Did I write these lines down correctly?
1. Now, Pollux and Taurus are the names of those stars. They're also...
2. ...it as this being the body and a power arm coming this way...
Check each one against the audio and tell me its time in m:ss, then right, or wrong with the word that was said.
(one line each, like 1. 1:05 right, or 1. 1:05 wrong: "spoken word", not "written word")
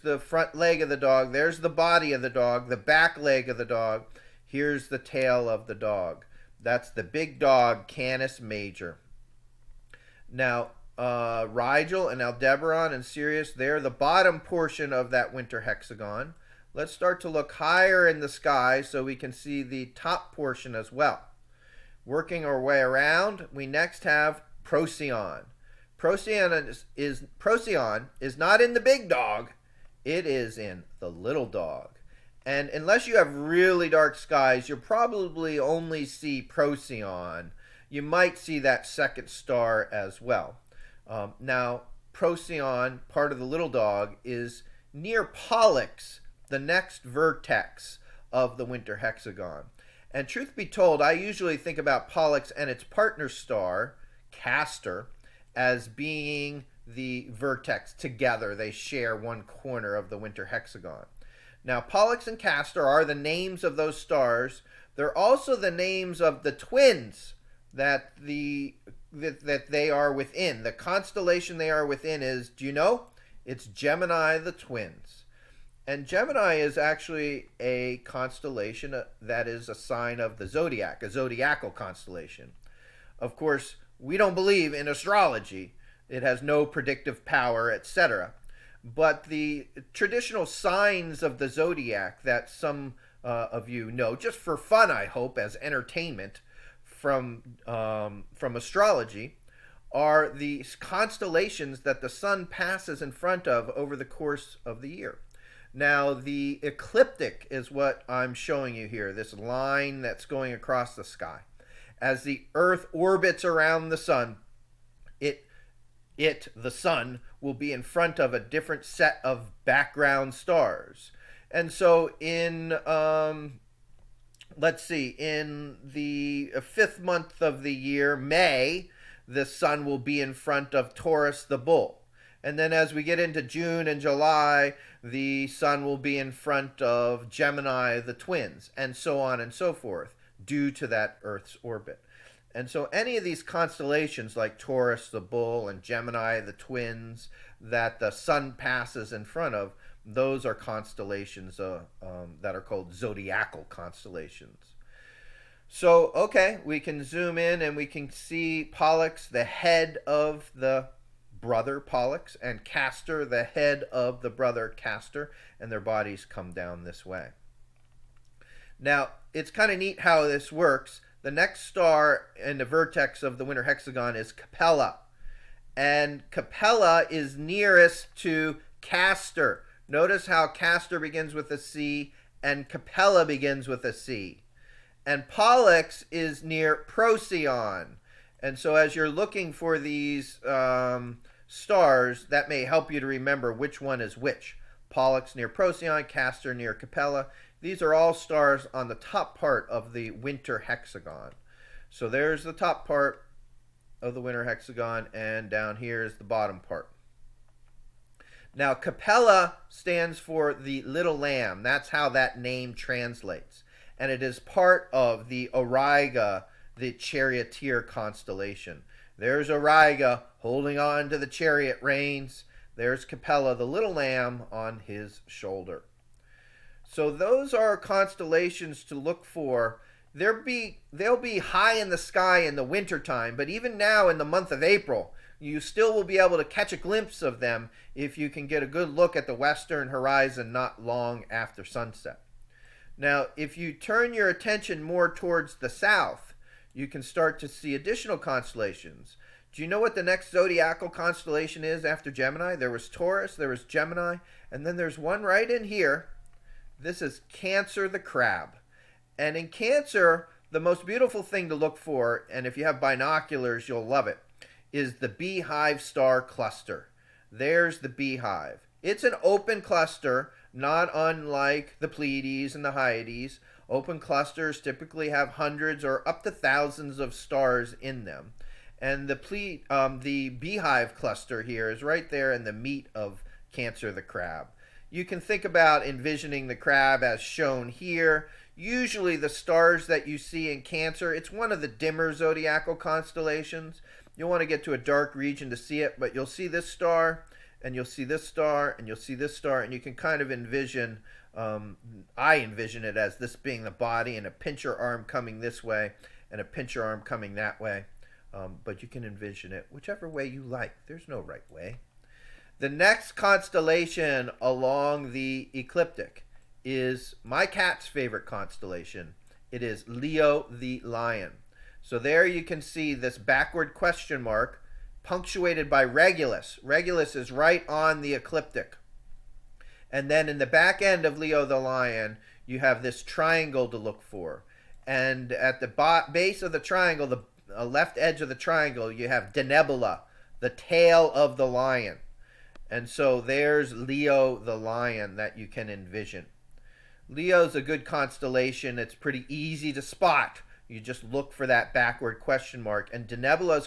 1. 1:01 wrong: "Castor", not "Taurus"
2. 5:02 wrong: "pincher", not "power".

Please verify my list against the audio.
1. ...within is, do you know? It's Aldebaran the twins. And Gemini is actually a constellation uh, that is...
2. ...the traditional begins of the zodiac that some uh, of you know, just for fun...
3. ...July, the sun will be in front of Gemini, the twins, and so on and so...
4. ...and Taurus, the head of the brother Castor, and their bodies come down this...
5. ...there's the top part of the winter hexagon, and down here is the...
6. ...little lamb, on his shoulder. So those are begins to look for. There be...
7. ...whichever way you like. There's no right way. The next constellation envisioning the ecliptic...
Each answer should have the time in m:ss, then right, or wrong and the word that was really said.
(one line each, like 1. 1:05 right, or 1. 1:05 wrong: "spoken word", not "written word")
1. 1:11 wrong: "Gemini", not "Aldebaran"
2. 1:29 wrong: "signs", not "begins"
3. 2:14 right
4. 2:42 wrong: "Castor", not "Taurus"
5. 3:22 right
6. 3:43 wrong: "constellations", not "begins"
7. 5:09 wrong: "along", not "envisioning".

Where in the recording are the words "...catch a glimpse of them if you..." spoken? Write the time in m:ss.
3:56.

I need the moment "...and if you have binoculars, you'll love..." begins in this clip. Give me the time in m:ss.
4:22.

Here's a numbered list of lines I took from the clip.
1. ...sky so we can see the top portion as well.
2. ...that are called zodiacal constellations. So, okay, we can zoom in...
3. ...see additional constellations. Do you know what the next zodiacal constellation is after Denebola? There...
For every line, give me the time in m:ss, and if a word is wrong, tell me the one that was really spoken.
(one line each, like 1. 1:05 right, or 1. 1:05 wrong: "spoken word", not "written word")
1. 0:18 right
2. 2:32 right
3. 4:07 wrong: "Gemini", not "Denebola".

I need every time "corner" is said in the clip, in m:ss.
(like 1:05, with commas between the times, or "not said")
0:59.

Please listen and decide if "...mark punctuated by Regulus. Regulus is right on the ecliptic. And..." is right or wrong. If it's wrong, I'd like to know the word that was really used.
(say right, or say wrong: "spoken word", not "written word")
right.